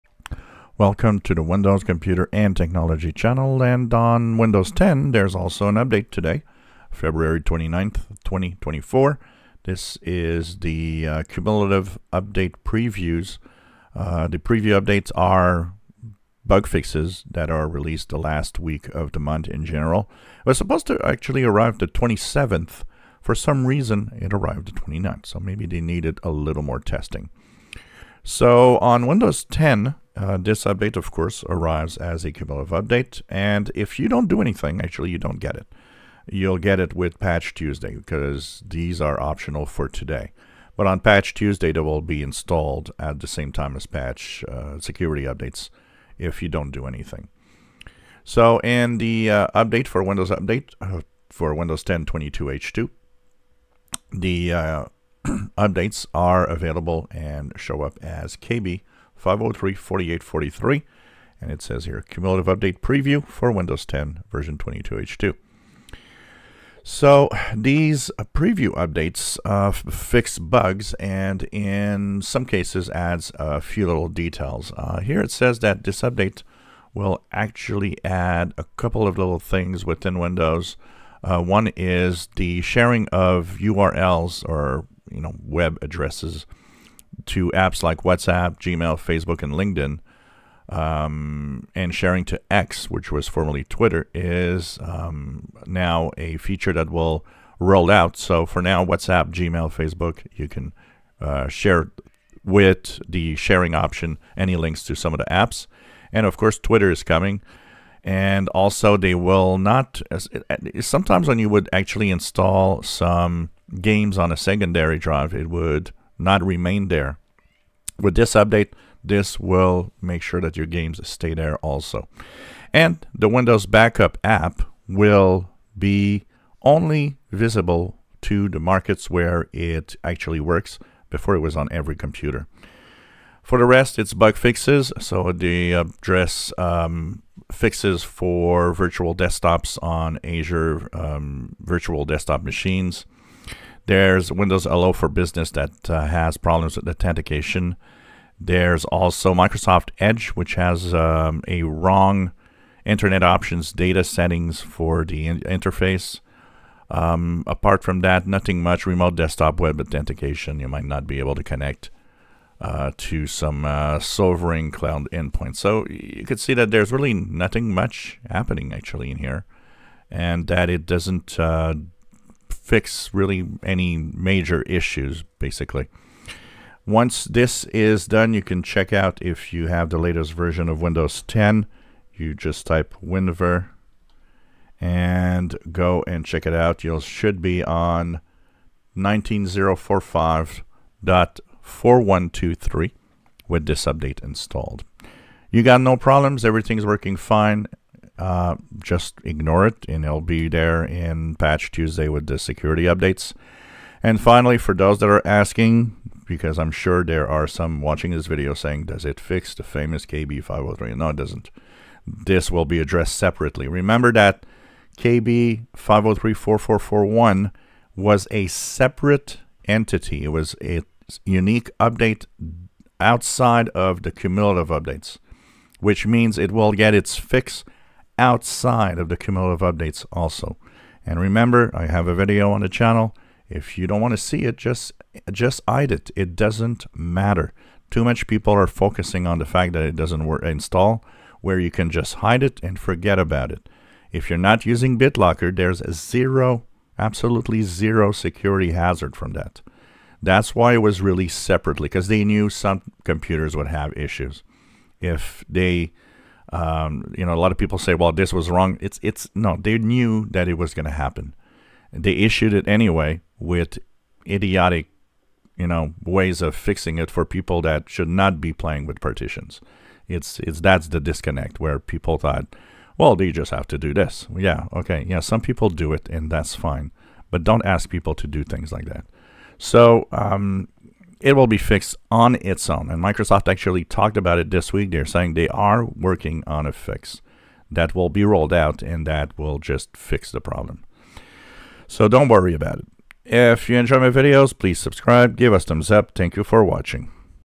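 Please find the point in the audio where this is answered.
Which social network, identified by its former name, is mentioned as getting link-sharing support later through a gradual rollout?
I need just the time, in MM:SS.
01:32.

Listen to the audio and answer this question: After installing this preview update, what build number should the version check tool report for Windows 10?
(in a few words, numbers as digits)
19045.4123.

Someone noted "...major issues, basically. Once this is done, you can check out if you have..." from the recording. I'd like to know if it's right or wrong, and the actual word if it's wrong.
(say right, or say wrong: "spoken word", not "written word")
right.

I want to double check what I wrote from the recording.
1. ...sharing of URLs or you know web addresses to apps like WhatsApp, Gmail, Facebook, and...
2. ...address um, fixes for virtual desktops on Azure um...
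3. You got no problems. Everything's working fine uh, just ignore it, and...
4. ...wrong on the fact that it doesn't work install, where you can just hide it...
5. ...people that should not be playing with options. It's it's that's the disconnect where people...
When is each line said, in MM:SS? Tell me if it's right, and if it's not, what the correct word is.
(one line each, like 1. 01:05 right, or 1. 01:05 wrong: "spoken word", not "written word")
1. 01:22 right
2. 02:15 right
3. 03:15 right
4. 03:58 wrong: "focusing", not "wrong"
5. 04:27 wrong: "partitions", not "options".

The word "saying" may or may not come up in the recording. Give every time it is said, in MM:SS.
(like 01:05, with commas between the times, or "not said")
03:28, 04:45.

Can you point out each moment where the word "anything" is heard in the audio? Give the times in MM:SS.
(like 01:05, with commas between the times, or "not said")
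00:34, 00:46.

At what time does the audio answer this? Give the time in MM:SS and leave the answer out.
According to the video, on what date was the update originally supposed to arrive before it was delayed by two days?
00:21.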